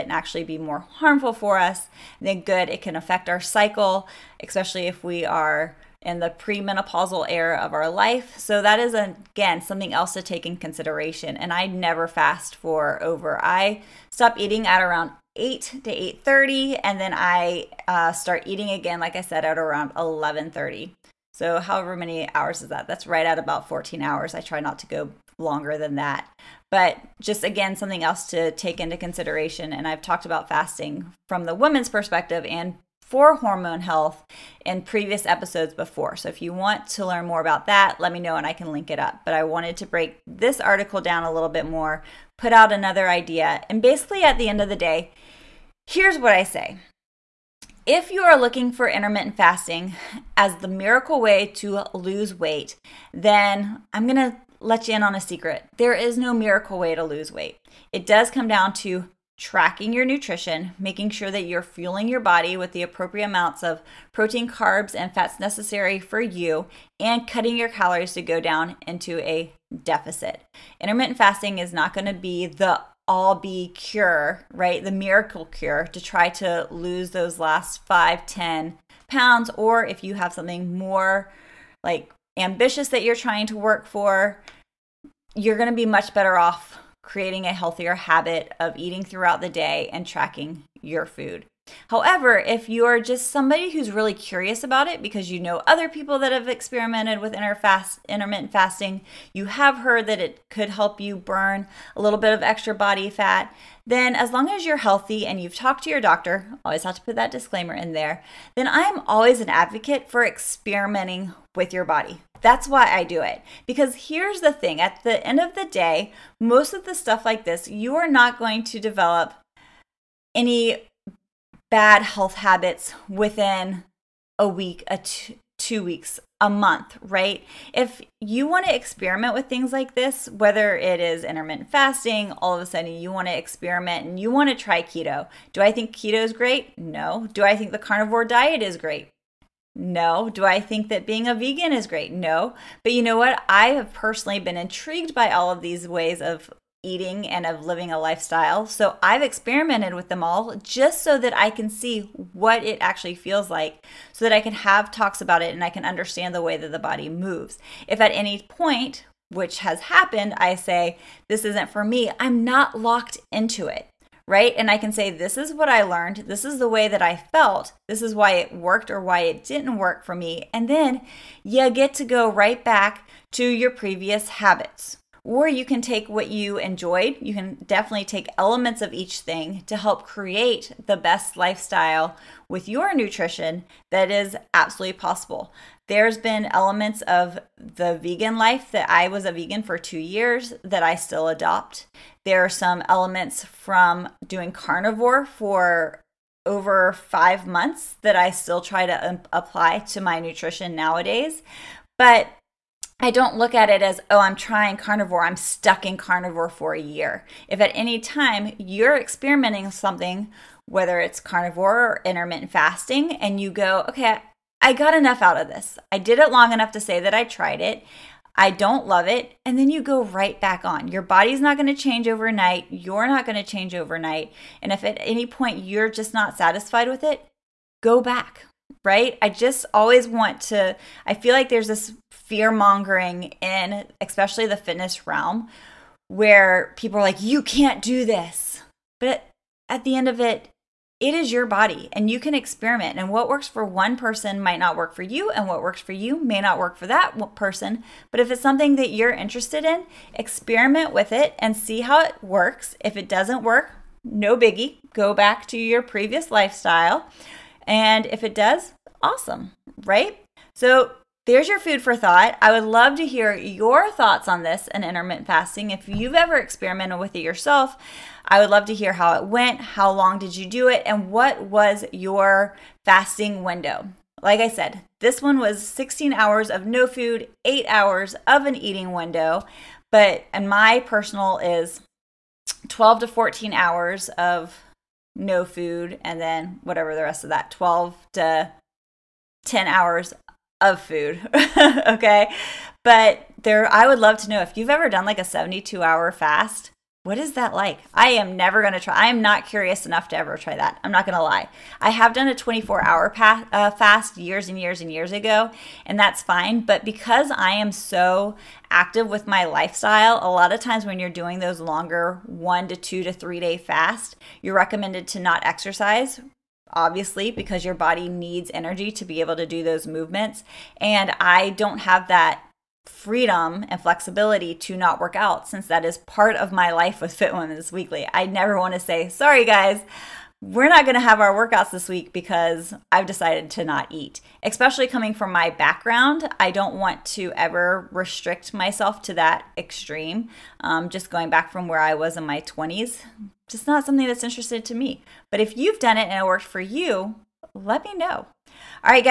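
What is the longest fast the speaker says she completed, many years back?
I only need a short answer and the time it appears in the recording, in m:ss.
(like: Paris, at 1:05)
24 hours, at 5:02.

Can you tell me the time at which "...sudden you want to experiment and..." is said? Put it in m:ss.
2:12.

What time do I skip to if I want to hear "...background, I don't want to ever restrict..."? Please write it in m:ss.
5:35.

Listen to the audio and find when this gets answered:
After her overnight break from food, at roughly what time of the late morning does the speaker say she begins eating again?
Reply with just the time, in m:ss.
0:19.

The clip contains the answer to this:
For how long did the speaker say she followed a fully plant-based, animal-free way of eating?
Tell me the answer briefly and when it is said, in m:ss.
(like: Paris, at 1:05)
2 years, at 3:09.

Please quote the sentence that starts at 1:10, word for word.
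Intermittent fasting is not going to be the all be cure, right?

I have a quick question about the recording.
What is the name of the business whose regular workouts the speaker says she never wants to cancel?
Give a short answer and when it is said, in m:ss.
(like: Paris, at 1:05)
Fit Women's Weekly, at 5:27.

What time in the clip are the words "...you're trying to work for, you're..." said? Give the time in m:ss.
1:23.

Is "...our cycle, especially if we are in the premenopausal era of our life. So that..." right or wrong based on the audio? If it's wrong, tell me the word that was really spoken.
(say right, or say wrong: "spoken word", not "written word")
right.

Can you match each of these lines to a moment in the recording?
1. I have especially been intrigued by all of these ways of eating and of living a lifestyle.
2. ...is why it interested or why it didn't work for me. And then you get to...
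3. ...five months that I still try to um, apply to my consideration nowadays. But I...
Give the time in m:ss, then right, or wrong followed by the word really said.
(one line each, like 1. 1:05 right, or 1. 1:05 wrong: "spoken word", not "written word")
1. 2:23 wrong: "personally", not "especially"
2. 2:48 wrong: "worked", not "interested"
3. 3:16 wrong: "nutrition", not "consideration".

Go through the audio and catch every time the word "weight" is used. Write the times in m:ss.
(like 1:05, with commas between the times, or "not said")
0:52, 0:57.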